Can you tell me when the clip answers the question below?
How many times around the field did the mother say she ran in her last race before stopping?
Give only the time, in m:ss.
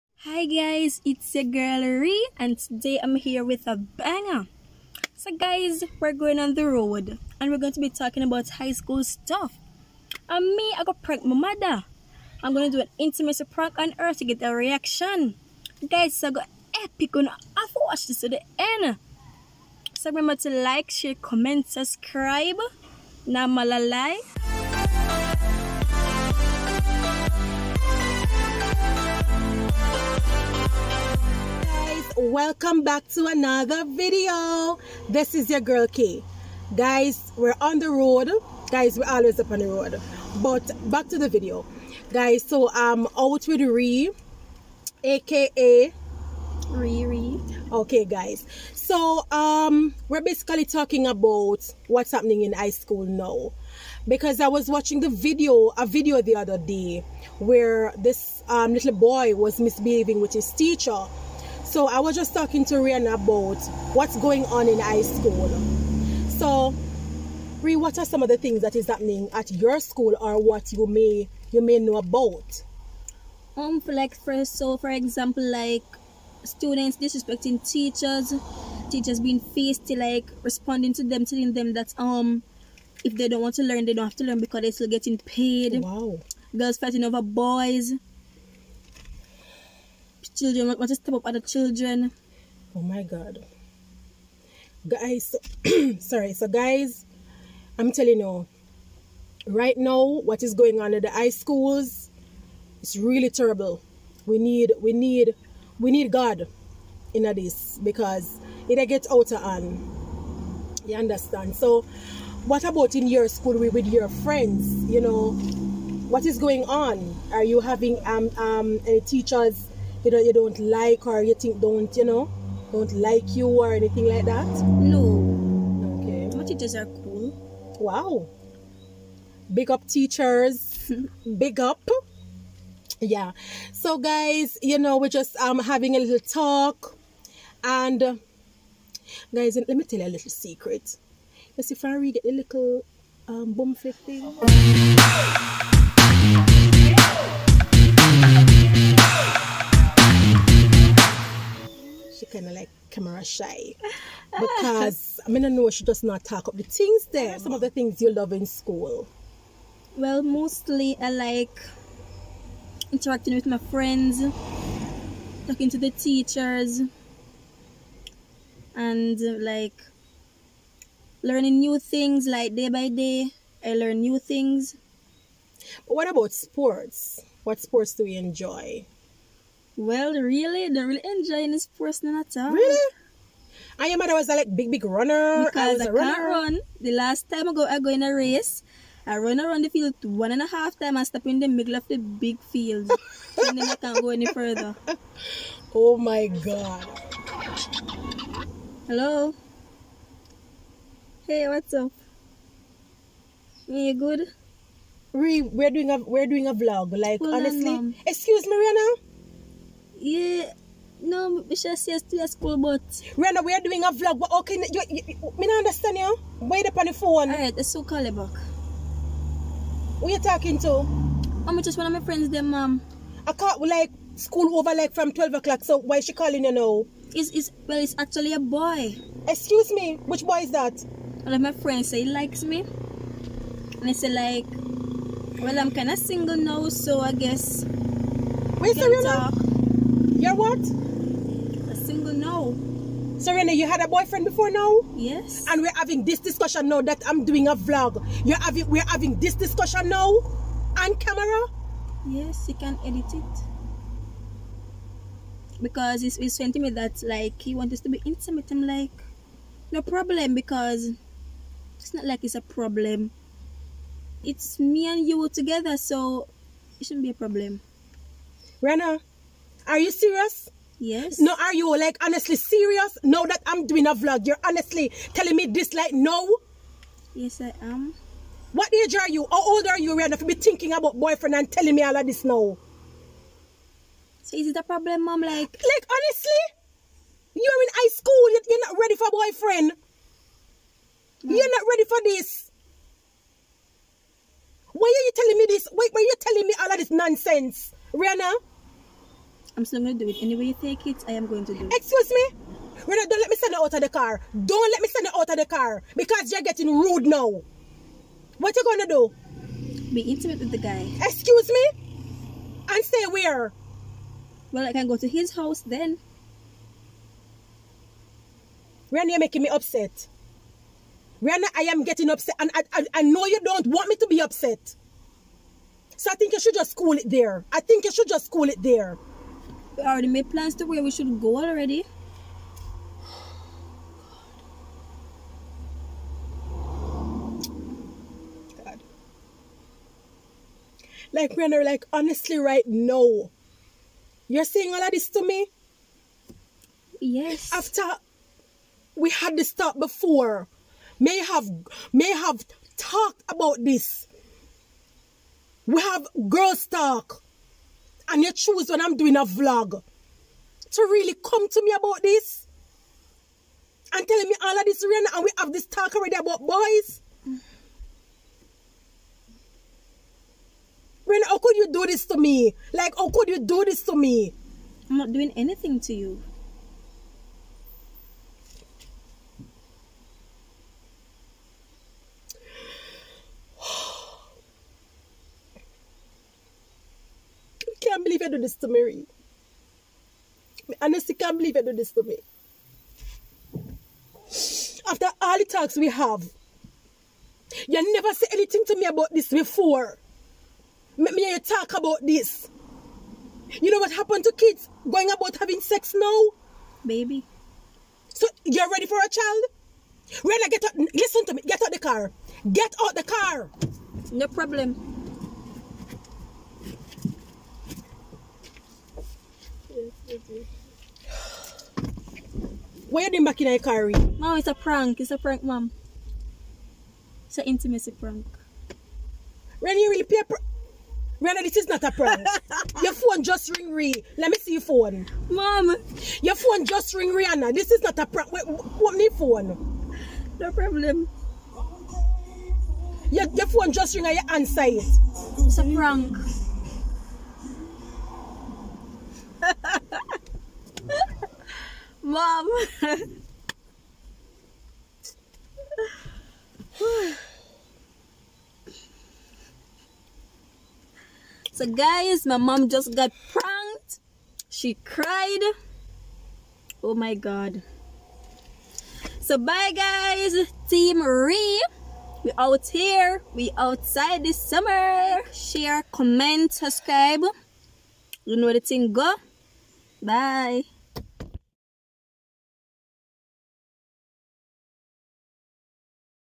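3:10.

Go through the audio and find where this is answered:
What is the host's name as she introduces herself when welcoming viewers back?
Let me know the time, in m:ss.
0:35.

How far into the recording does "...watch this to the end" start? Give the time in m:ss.
0:17.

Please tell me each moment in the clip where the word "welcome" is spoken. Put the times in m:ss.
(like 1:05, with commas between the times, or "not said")
0:32.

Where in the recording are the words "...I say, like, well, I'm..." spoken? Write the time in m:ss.
3:53.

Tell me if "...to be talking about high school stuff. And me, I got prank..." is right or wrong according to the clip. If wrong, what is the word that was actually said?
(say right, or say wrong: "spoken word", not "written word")
right.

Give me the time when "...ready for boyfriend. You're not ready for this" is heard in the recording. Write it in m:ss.
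4:48.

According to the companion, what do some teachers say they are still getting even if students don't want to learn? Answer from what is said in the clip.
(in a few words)
Paid.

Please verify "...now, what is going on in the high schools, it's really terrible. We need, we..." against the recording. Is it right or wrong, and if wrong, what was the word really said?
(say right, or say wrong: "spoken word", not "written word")
right.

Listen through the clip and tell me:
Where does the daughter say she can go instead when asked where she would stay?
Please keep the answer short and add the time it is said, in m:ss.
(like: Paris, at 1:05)
His house, at 5:15.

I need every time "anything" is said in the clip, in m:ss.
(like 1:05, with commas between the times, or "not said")
2:03, 6:15, 6:38.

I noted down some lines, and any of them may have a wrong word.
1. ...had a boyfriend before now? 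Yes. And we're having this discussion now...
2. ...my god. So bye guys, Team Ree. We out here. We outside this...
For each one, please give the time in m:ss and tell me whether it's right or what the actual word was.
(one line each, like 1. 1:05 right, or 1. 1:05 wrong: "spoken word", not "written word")
1. 4:03 right
2. 7:46 right.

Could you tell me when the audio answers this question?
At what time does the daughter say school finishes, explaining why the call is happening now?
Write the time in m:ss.
3:45.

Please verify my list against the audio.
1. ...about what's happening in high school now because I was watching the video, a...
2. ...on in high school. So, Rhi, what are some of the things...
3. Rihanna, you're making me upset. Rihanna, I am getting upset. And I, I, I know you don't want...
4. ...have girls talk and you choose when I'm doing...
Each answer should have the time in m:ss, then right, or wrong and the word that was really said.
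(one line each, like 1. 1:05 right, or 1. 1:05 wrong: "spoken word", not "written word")
1. 0:51 right
2. 1:04 right
3. 5:18 right
4. 5:55 right.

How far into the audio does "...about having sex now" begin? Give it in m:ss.
6:45.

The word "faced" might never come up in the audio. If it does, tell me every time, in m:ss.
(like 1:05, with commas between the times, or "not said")
not said.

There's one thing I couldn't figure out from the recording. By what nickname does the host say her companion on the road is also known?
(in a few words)
Riri.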